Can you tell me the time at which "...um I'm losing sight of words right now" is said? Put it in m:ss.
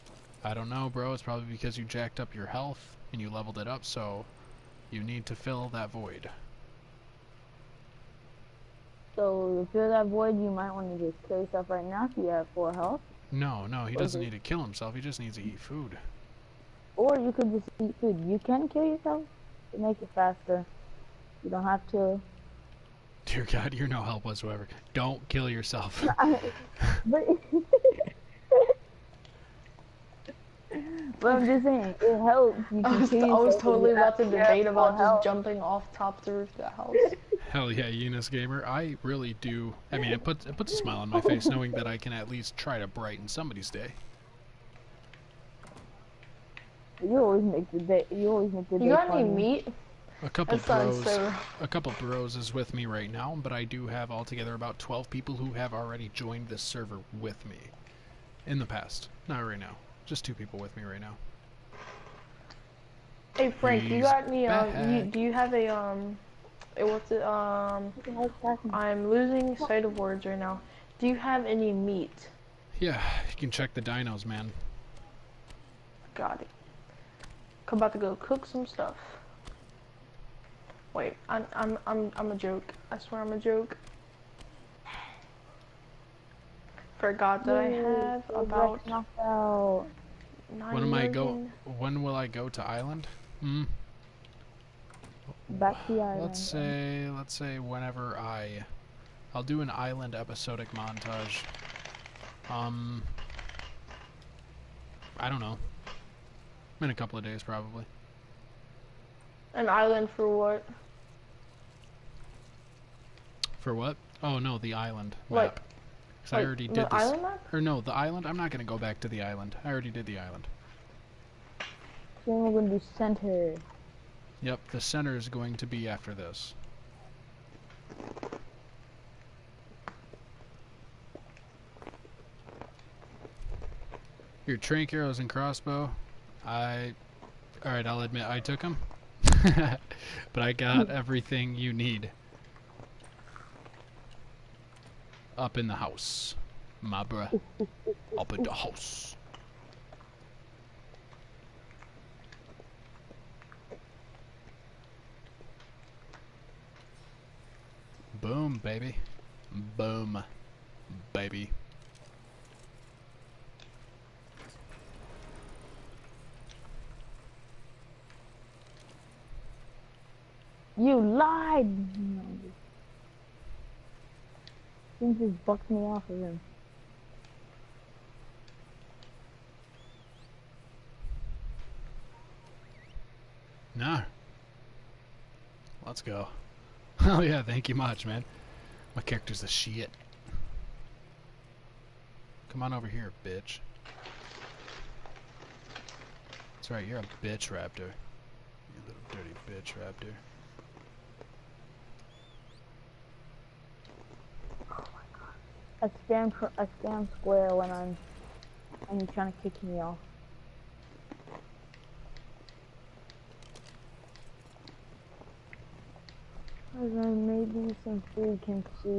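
1:07.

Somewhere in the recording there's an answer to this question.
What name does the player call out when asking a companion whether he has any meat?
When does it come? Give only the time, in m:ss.
1:03.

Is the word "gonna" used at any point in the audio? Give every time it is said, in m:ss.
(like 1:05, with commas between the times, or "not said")
1:58, 2:02.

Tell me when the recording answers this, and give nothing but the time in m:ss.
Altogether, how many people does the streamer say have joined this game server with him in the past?
0:54.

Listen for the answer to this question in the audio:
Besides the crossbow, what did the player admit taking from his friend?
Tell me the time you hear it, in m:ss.
2:14.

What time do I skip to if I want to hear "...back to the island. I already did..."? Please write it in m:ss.
1:58.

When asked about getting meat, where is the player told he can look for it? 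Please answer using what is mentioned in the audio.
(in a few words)
the dinos.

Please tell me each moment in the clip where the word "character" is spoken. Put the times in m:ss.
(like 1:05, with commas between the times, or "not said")
3:09.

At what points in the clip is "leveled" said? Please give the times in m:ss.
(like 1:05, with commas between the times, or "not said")
0:03.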